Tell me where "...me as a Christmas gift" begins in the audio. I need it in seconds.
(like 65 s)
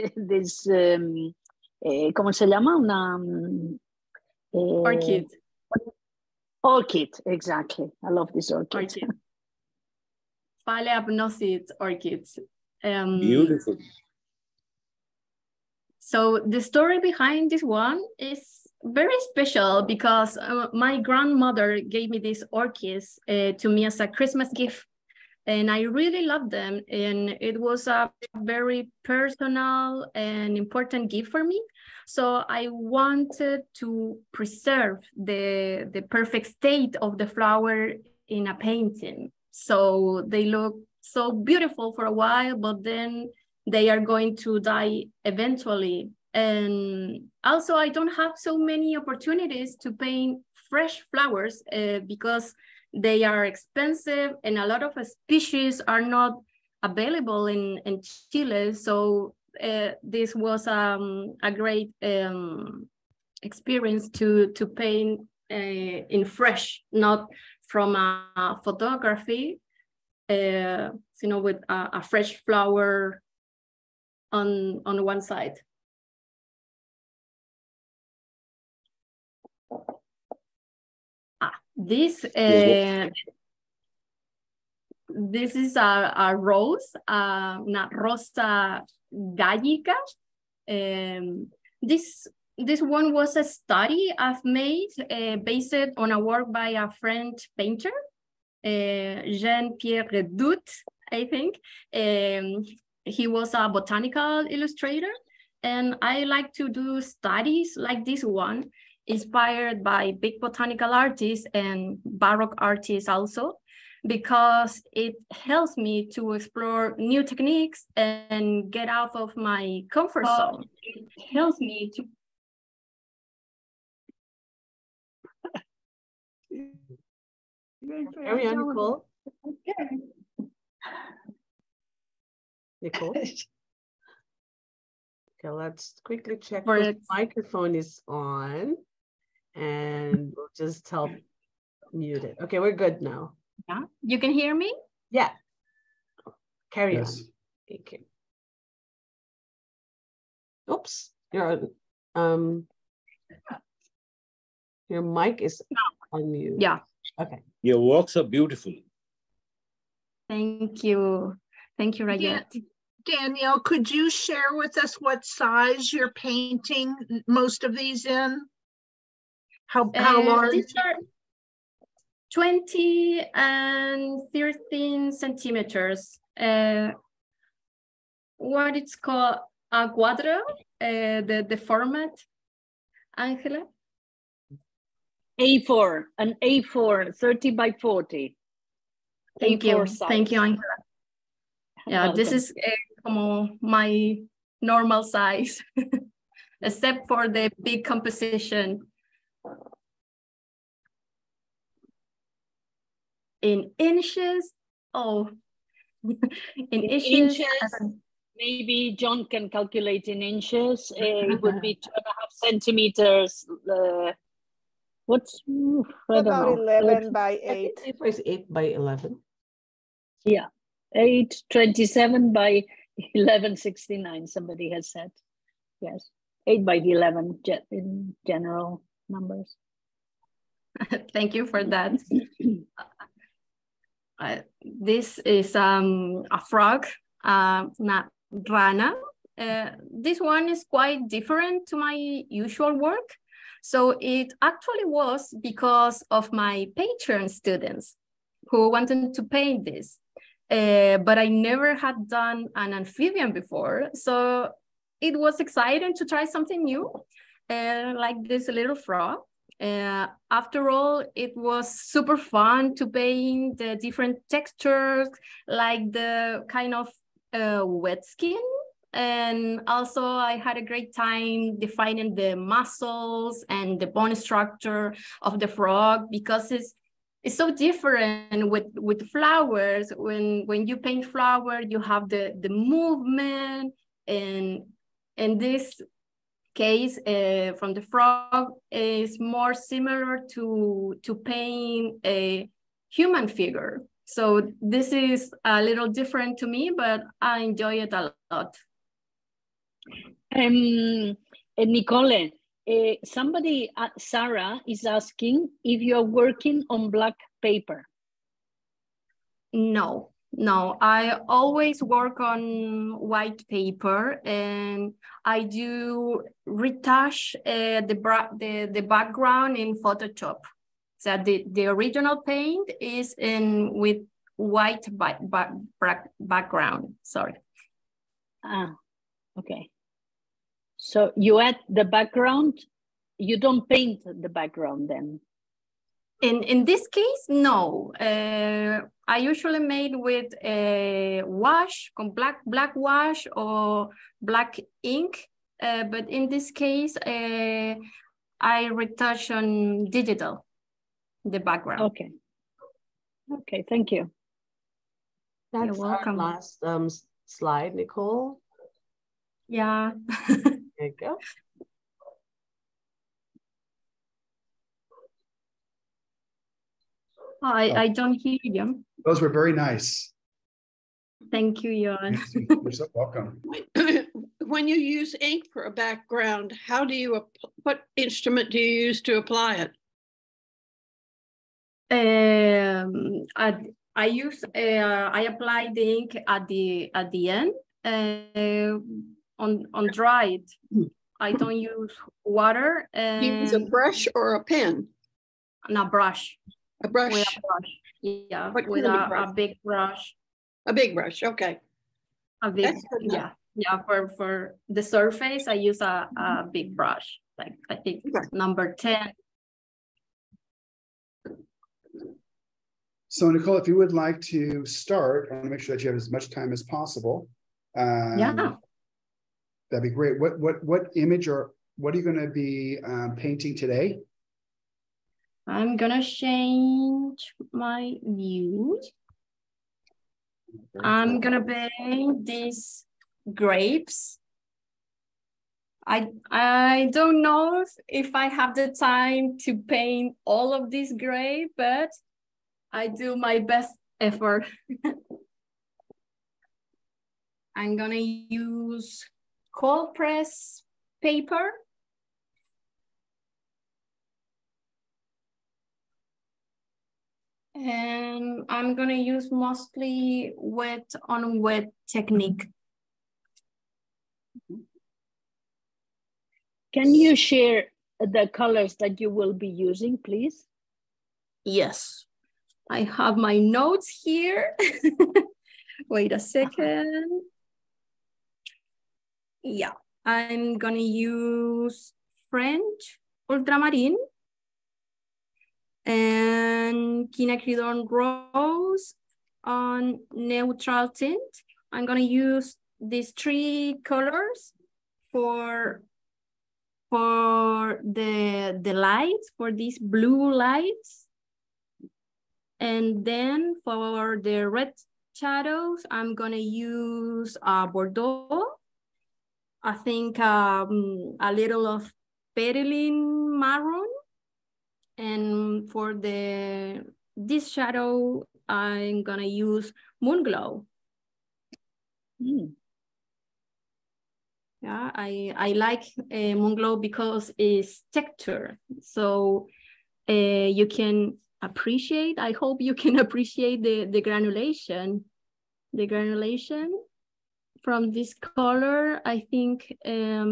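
23 s.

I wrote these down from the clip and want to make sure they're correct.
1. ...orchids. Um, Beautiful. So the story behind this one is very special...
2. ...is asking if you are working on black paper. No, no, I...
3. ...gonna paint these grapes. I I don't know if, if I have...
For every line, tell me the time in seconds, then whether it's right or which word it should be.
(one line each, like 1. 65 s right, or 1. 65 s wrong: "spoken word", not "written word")
1. 11 s right
2. 304 s right
3. 431 s right.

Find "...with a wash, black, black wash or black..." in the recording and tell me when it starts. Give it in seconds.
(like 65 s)
339 s.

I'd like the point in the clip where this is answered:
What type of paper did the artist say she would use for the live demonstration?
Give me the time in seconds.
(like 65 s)
449 s.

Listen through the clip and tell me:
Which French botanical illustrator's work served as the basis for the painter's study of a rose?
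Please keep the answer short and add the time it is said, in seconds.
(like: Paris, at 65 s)
Jean-Pierre Redouté, at 99 s.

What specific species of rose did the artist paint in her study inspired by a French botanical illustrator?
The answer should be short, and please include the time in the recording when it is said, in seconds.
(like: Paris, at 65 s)
Rosa gallica, at 87 s.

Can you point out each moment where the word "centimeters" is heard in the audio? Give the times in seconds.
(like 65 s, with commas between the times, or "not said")
175 s, 212 s.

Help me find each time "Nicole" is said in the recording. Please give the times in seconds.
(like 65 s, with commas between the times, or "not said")
128 s, 132 s, 301 s, 357 s, 413 s.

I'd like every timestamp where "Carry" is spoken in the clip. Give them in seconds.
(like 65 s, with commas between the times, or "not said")
128 s, 146 s.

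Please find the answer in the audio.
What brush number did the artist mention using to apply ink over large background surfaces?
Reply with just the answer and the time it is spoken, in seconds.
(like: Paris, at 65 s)
10, at 408 s.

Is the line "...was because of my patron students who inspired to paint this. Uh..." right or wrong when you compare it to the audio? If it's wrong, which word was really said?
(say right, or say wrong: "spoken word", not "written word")
wrong: "wanted", not "inspired".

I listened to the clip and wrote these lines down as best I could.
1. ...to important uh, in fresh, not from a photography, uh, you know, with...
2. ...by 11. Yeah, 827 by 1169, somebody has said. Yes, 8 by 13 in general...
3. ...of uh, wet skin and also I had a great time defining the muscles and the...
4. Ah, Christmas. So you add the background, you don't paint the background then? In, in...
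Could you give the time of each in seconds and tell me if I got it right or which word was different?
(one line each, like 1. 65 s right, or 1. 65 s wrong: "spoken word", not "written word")
1. 64 s wrong: "paint", not "important"
2. 218 s wrong: "11", not "13"
3. 266 s right
4. 328 s wrong: "Okay", not "Christmas".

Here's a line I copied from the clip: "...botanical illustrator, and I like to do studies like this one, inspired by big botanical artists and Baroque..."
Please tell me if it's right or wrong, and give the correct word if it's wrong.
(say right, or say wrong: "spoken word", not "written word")
right.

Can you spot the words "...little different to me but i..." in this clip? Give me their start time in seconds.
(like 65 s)
295 s.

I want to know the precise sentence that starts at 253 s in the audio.
So it was exciting to try something new, uh, like this little frog.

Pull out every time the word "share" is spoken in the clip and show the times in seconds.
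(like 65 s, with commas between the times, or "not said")
164 s, 467 s.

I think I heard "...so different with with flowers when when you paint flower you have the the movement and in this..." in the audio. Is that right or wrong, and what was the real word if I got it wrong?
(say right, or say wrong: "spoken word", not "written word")
right.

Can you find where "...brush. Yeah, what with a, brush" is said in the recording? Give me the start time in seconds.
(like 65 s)
397 s.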